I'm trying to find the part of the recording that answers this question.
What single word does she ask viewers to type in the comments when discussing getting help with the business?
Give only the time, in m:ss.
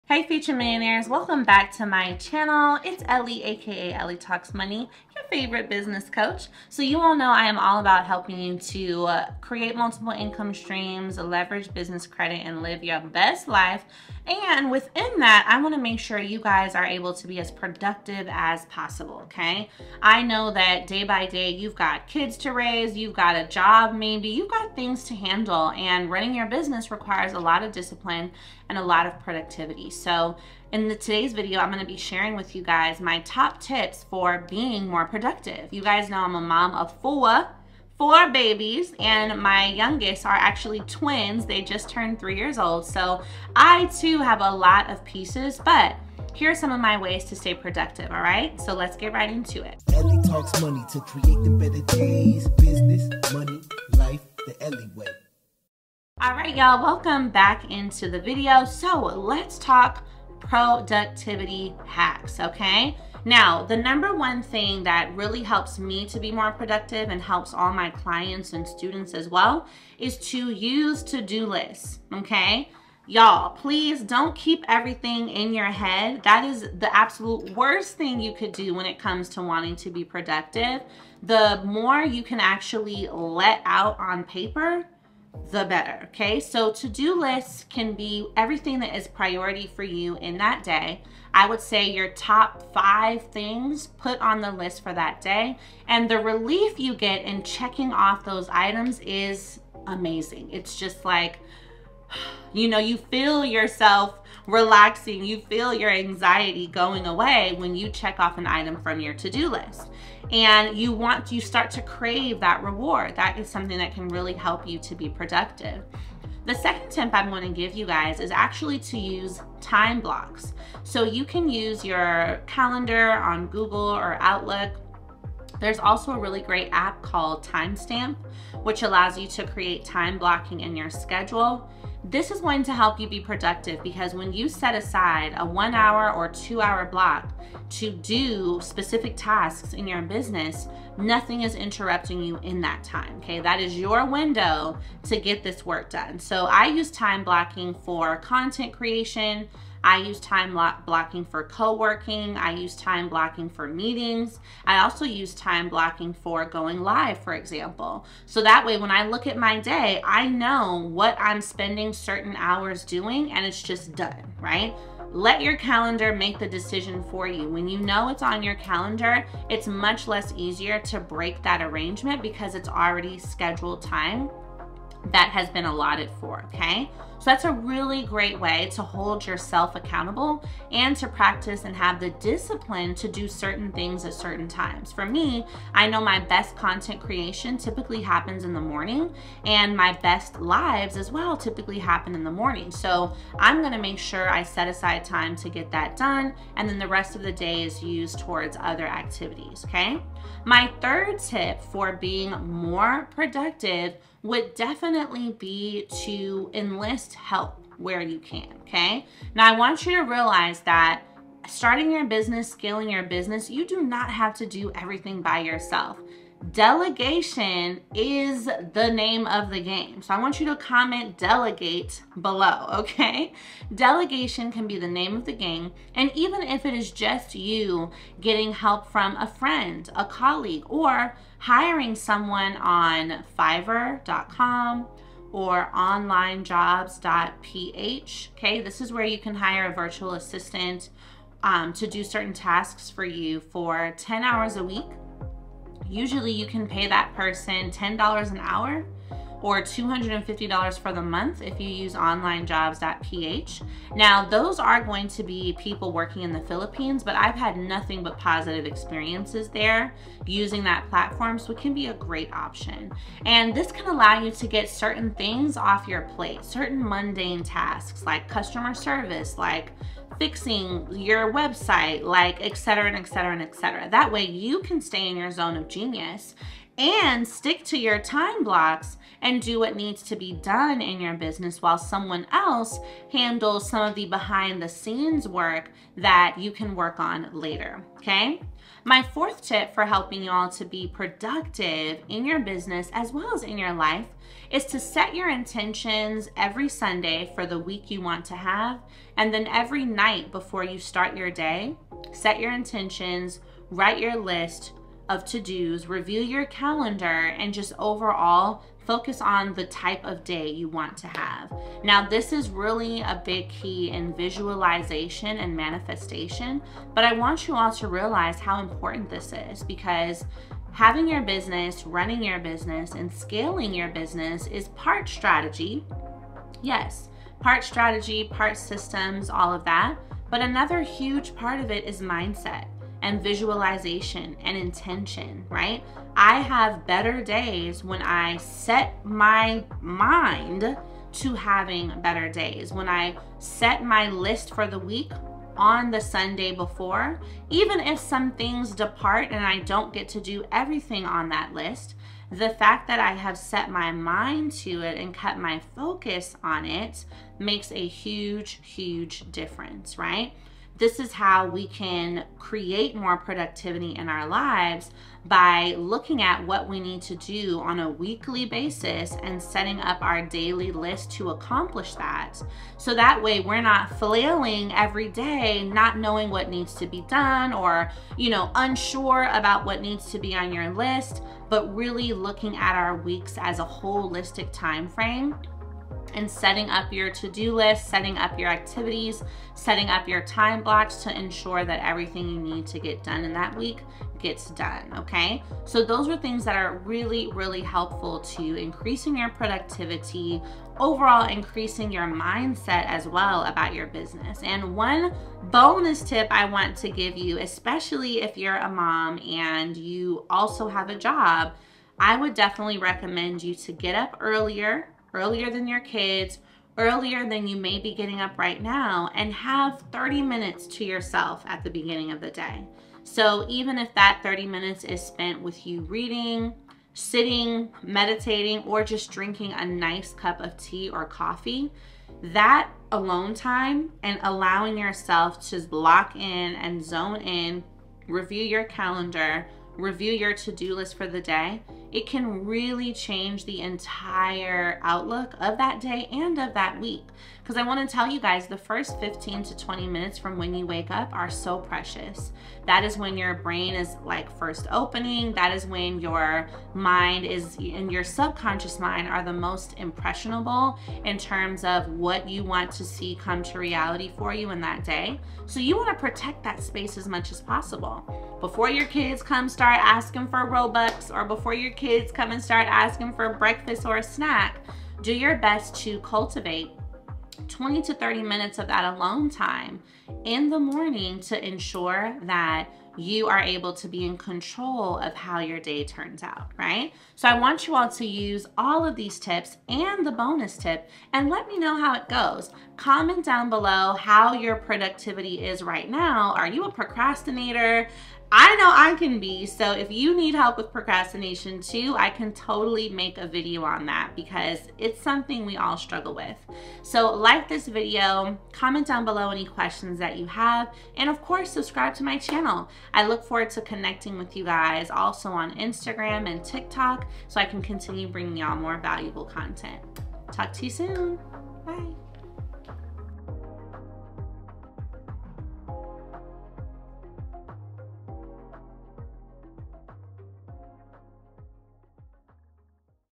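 3:41.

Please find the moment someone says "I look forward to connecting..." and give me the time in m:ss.
8:32.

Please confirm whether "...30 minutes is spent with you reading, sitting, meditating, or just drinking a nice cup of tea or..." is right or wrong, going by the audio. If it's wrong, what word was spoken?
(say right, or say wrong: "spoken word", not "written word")
right.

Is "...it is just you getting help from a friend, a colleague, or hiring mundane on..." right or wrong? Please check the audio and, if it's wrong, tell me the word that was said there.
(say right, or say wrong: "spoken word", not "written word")
wrong: "someone", not "mundane".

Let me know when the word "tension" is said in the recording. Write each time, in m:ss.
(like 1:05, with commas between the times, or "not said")
not said.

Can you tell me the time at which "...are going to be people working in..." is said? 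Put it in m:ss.
4:14.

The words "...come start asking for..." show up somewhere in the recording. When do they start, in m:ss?
7:49.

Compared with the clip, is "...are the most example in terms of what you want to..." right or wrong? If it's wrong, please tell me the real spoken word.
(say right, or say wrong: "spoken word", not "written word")
wrong: "impressionable", not "example".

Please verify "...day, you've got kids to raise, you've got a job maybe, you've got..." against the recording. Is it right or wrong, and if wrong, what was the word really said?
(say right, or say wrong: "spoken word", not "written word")
right.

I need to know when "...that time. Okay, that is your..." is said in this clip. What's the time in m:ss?
2:22.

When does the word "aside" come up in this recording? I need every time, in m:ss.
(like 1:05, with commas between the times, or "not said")
2:14, 3:14.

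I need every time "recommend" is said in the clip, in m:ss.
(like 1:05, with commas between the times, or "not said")
6:52.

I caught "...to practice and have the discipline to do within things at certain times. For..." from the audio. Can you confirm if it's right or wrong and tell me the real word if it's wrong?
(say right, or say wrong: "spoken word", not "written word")
wrong: "certain", not "within".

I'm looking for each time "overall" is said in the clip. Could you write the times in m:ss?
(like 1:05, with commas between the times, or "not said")
5:07, 6:40.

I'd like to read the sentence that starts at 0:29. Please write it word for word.
So in the, today's video, I'm gonna be sharing with you guys my top tips for being more productive.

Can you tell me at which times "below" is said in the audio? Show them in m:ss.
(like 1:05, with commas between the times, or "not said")
3:42, 8:13, 8:29.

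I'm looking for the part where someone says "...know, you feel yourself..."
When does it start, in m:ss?
1:42.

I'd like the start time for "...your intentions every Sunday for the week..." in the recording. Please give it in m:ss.
4:55.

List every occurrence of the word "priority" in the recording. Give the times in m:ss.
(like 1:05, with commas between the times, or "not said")
1:29.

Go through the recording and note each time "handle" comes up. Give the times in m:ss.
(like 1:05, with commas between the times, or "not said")
0:25, 4:43.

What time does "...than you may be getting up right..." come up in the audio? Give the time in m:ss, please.
6:57.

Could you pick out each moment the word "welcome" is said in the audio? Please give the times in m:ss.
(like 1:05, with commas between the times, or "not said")
0:01, 0:56.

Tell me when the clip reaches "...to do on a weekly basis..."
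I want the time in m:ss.
6:07.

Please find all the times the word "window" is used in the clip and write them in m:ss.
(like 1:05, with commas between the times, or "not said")
2:24.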